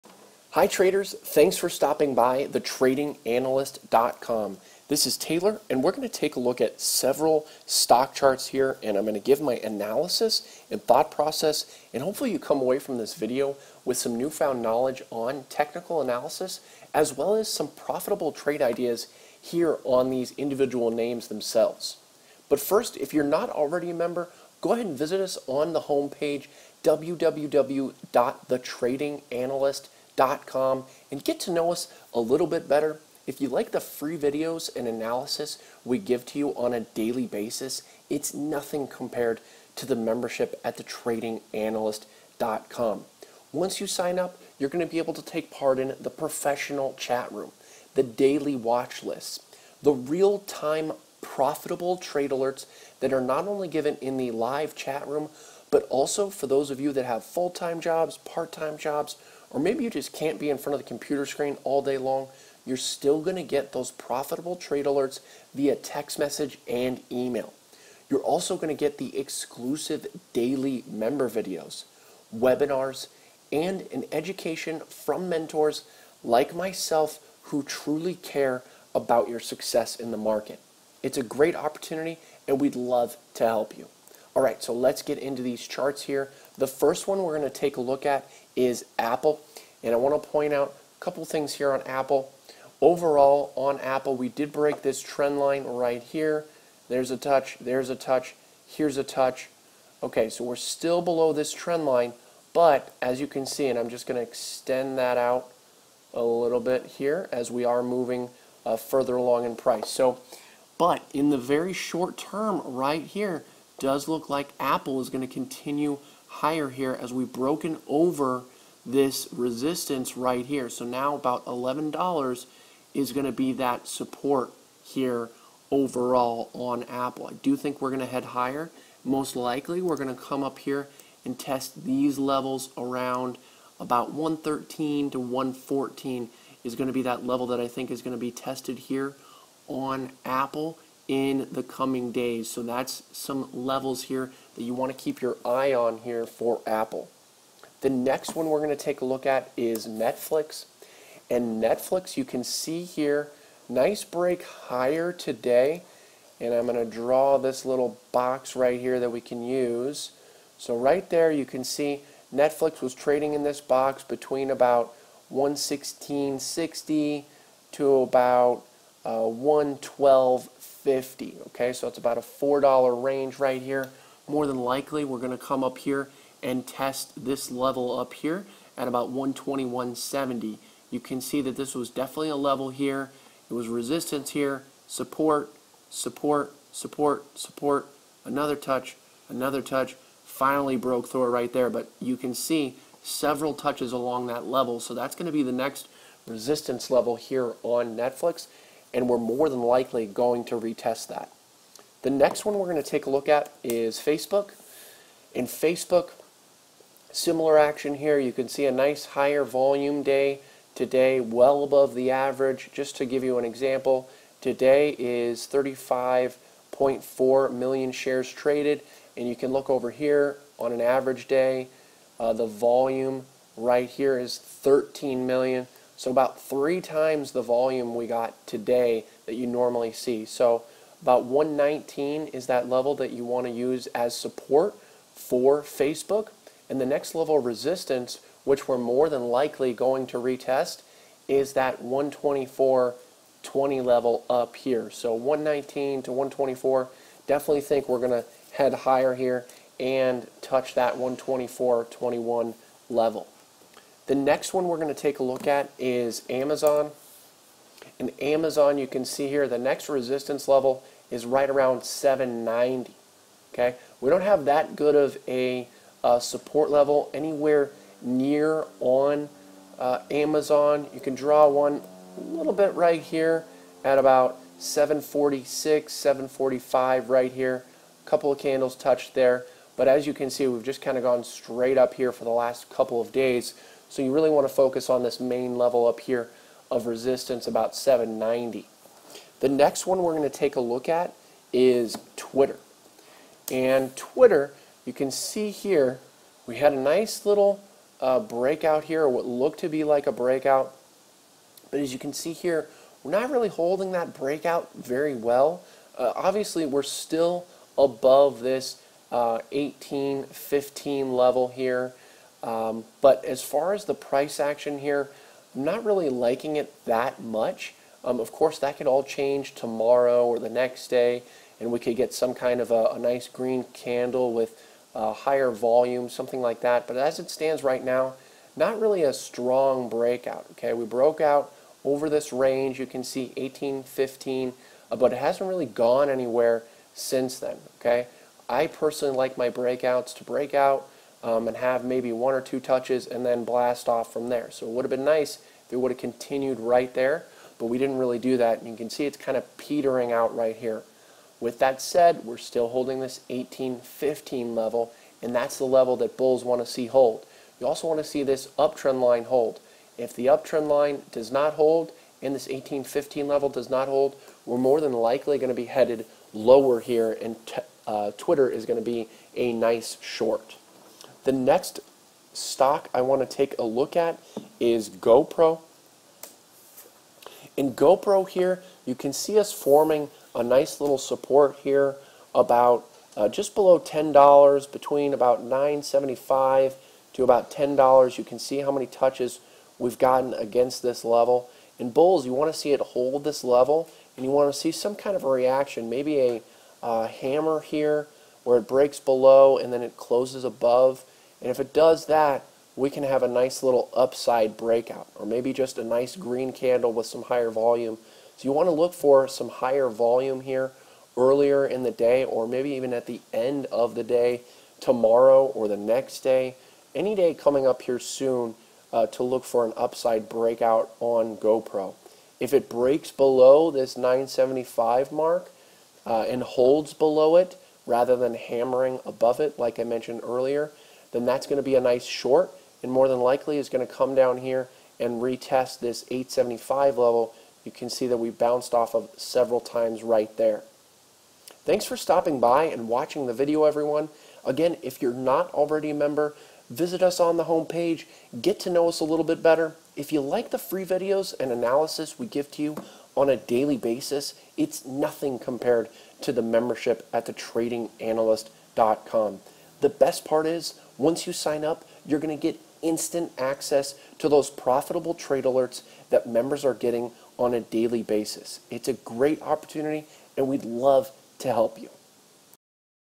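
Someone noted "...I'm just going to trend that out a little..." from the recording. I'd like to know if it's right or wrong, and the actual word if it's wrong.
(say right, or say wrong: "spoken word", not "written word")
wrong: "extend", not "trend".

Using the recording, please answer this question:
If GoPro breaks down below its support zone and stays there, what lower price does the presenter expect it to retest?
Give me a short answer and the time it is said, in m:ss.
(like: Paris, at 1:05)
875, at 7:16.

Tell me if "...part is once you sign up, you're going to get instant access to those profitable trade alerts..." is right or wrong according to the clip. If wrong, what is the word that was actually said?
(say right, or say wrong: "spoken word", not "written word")
right.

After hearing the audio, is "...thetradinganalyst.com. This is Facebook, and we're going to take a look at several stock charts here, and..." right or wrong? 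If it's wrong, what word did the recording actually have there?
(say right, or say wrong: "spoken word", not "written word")
wrong: "Taylor", not "Facebook".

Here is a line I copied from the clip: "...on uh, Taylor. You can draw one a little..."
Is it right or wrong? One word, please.
wrong.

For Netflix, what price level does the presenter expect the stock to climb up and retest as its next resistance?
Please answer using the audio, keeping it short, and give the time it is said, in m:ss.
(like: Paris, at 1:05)
121.70, at 2:59.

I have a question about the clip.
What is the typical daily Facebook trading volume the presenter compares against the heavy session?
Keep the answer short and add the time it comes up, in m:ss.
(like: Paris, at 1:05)
13 million, at 3:44.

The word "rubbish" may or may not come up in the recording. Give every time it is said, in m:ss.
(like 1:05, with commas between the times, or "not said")
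not said.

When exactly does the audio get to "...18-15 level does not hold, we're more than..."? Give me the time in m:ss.
6:02.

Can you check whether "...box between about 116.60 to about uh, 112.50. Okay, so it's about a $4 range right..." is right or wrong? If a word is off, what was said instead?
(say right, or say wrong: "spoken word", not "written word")
right.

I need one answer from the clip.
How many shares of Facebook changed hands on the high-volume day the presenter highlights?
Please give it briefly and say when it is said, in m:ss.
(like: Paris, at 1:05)
35.4 million, at 3:35.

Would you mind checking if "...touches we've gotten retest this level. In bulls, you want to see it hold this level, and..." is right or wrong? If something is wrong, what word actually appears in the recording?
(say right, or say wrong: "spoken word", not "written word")
wrong: "against", not "retest".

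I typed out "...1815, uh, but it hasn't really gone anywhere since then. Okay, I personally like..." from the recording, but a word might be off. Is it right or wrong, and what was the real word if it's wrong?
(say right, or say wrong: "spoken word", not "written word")
right.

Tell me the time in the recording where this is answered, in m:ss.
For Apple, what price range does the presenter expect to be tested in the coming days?
2:14.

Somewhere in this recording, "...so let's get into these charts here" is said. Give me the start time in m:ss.
1:24.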